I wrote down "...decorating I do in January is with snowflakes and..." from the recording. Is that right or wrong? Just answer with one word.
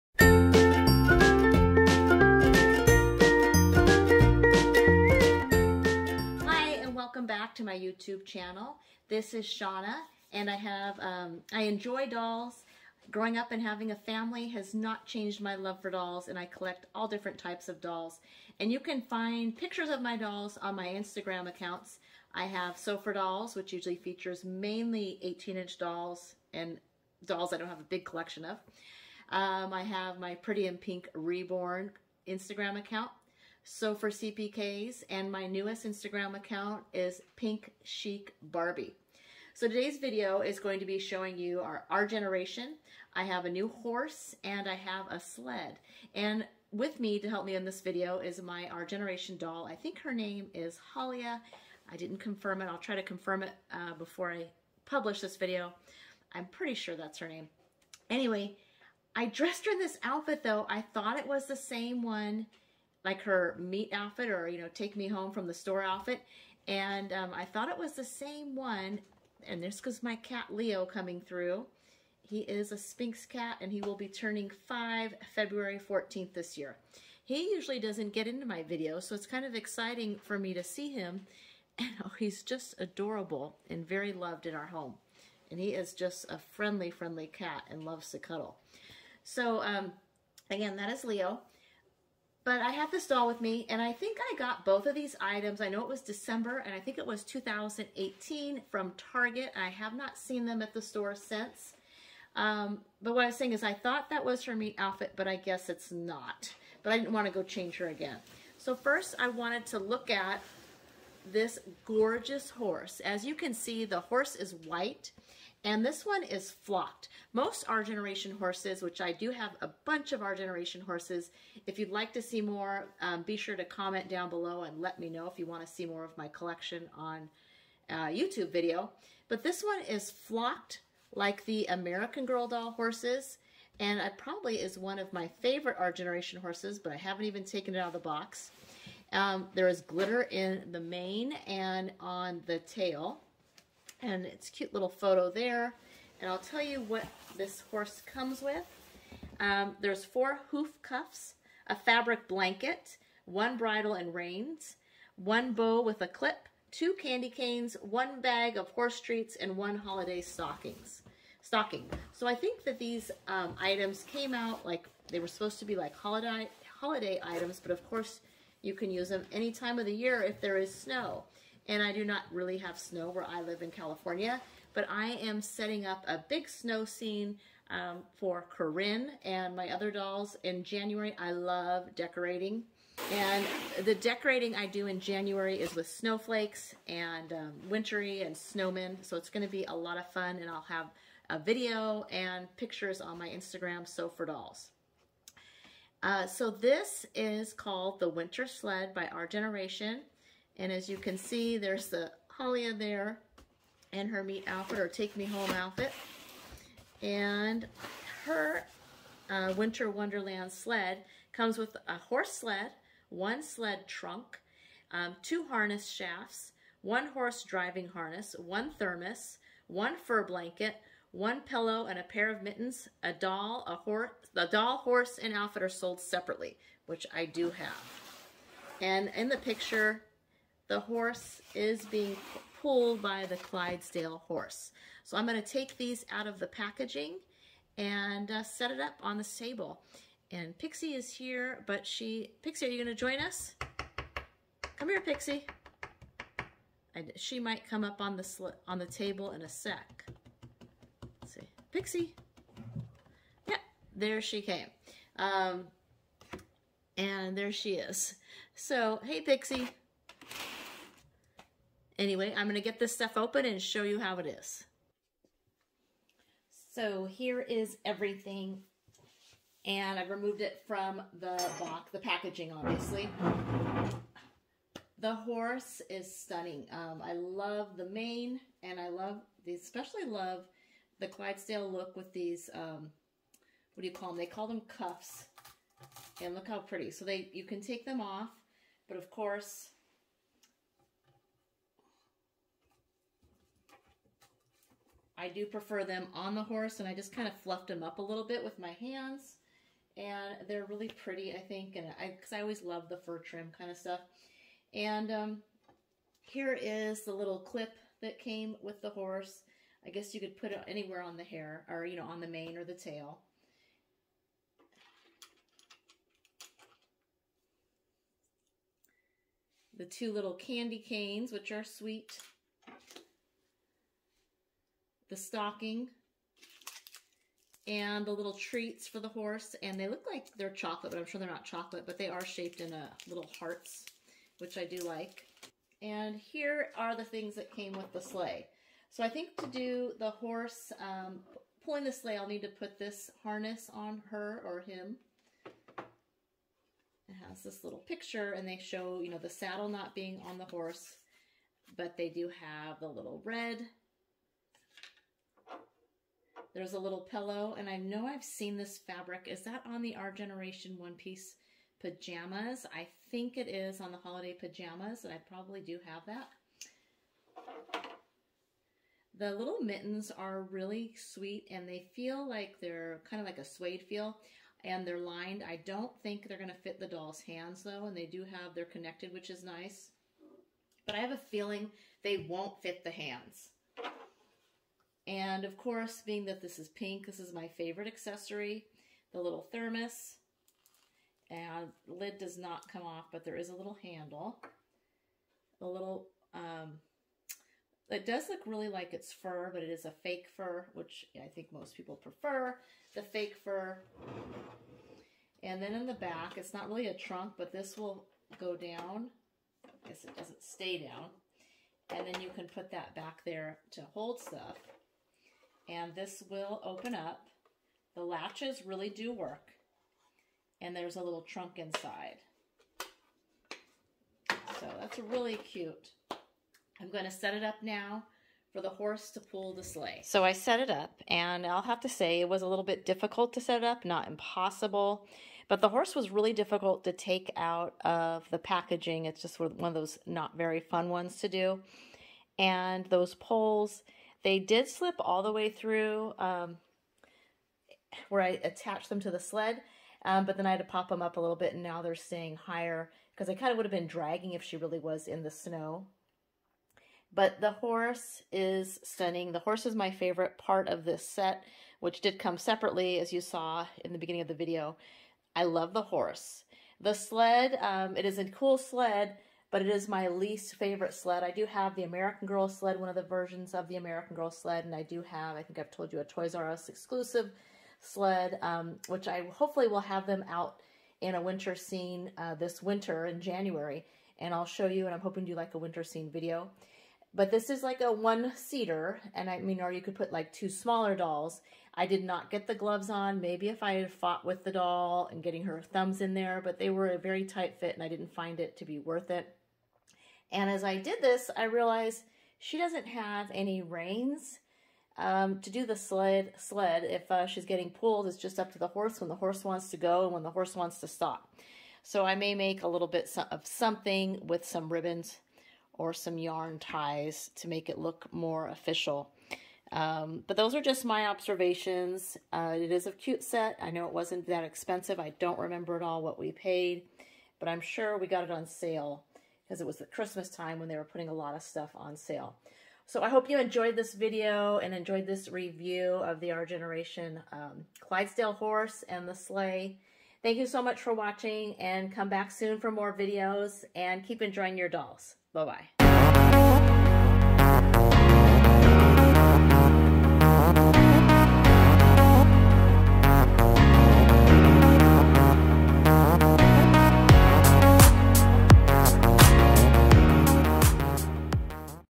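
right.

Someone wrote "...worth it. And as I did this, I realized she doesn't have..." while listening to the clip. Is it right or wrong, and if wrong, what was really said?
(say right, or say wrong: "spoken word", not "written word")
right.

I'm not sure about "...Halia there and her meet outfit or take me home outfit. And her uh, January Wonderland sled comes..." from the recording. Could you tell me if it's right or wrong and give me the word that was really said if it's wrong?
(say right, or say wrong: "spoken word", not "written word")
wrong: "Winter", not "January".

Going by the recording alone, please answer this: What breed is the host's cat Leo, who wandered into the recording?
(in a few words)
Sphynx.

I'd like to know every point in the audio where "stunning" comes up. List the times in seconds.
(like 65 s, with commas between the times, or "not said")
276 s, 458 s.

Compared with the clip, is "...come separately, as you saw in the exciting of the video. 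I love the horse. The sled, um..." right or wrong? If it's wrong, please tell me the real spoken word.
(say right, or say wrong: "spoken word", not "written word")
wrong: "beginning", not "exciting".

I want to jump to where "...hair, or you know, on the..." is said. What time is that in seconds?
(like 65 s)
311 s.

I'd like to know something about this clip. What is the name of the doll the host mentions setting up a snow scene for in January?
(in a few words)
Corinne.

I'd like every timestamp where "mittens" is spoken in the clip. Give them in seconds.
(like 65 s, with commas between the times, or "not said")
222 s, 369 s.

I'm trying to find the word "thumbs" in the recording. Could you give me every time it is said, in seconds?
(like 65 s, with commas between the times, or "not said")
495 s.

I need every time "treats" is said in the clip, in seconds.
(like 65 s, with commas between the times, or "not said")
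159 s, 328 s.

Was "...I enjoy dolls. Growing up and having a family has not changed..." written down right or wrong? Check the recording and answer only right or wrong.
right.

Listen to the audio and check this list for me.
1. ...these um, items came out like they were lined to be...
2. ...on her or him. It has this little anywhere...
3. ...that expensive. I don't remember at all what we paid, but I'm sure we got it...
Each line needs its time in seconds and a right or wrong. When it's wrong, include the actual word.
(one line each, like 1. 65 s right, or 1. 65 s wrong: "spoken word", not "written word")
1. 162 s wrong: "supposed", not "lined"
2. 343 s wrong: "picture", not "anywhere"
3. 524 s right.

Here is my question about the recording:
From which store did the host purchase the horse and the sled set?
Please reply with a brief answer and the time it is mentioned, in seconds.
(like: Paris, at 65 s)
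Target, at 99 s.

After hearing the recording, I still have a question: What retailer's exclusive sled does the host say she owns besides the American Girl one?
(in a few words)
Toys R Us.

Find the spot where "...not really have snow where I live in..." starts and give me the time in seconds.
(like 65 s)
172 s.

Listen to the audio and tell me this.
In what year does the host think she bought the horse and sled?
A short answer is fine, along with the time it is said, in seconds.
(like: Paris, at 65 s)
2018, at 97 s.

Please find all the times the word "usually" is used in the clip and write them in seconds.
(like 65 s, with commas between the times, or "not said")
23 s, 77 s.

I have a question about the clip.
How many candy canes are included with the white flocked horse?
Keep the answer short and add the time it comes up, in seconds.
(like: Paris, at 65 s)
2, at 156 s.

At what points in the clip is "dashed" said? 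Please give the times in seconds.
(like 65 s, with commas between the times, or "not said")
not said.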